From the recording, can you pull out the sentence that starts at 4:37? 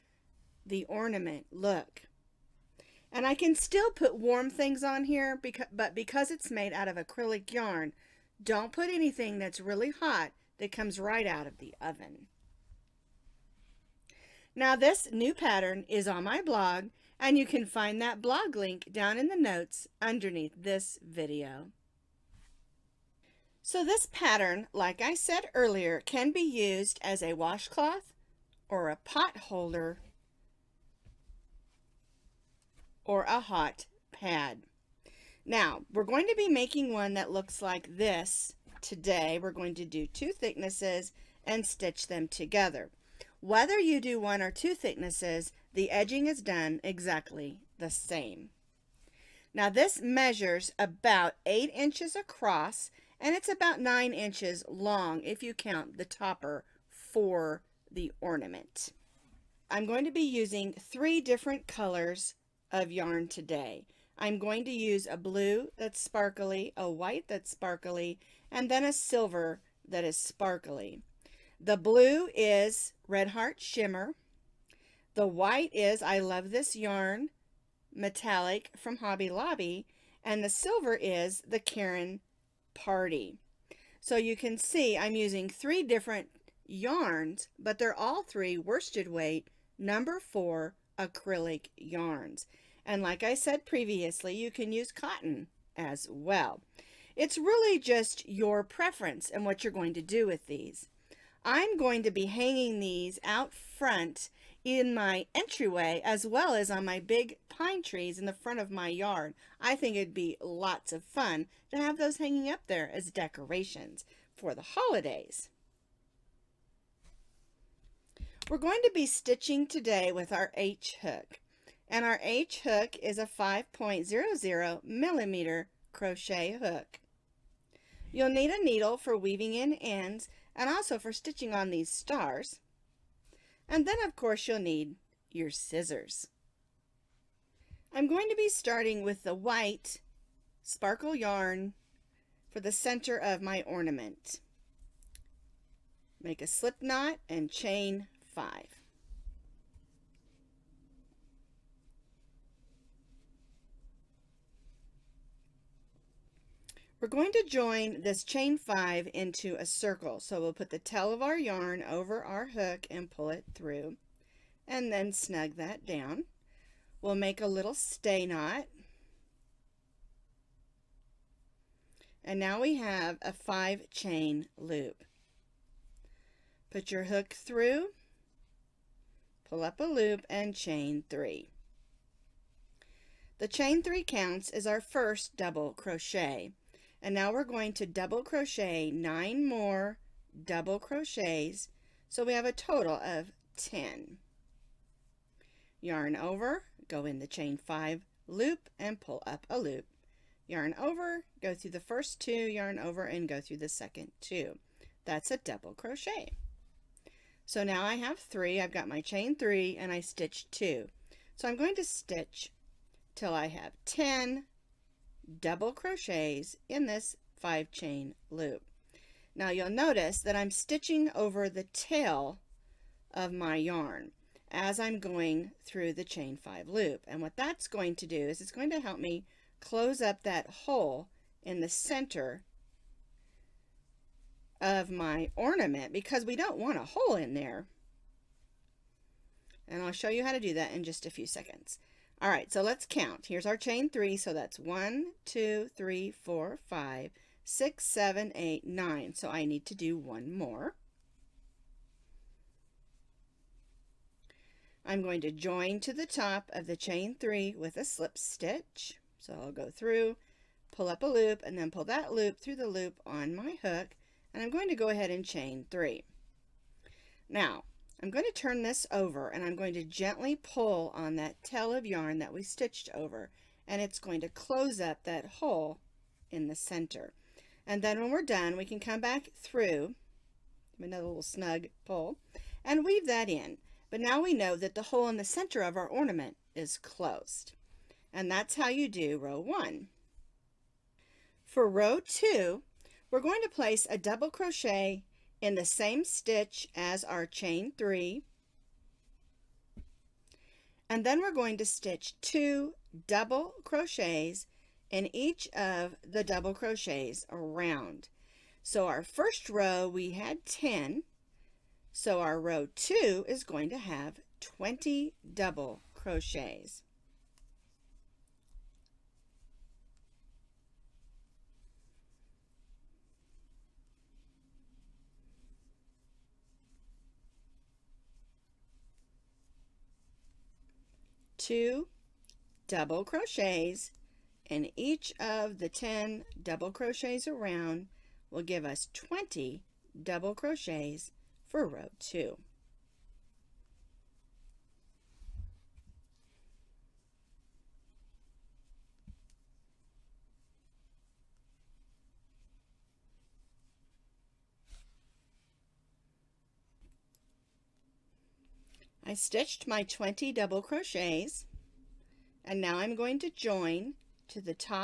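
And then when we're done, we can come back through, another little snug pull, and weave that in.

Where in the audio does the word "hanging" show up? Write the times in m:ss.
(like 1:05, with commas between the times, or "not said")
1:42, 1:52.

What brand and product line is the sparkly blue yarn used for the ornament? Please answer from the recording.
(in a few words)
Red Heart Shimmer.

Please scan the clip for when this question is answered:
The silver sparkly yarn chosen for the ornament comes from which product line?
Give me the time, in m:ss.
1:21.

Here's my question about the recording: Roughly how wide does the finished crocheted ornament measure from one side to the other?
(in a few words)
8 inches.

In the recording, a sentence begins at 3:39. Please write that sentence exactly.
Now you'll notice that I'm stitching over the tail of my yarn as I'm going through the chain five loop.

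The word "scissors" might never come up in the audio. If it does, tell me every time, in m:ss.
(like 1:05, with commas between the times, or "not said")
2:15.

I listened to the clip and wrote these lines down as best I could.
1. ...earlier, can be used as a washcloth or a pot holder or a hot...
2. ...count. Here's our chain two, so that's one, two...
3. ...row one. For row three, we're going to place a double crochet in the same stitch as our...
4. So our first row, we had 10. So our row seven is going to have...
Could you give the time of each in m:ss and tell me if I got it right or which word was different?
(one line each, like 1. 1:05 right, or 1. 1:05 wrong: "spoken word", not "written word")
1. 0:25 right
2. 4:02 wrong: "three", not "two"
3. 4:49 wrong: "two", not "three"
4. 5:08 wrong: "two", not "seven".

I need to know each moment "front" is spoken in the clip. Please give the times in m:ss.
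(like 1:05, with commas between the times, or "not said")
1:43, 1:48.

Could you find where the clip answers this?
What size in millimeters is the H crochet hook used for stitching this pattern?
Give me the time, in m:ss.
2:03.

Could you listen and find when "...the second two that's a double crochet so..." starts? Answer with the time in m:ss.
3:23.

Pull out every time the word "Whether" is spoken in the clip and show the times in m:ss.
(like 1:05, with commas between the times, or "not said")
0:43.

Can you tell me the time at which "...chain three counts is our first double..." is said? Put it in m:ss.
3:03.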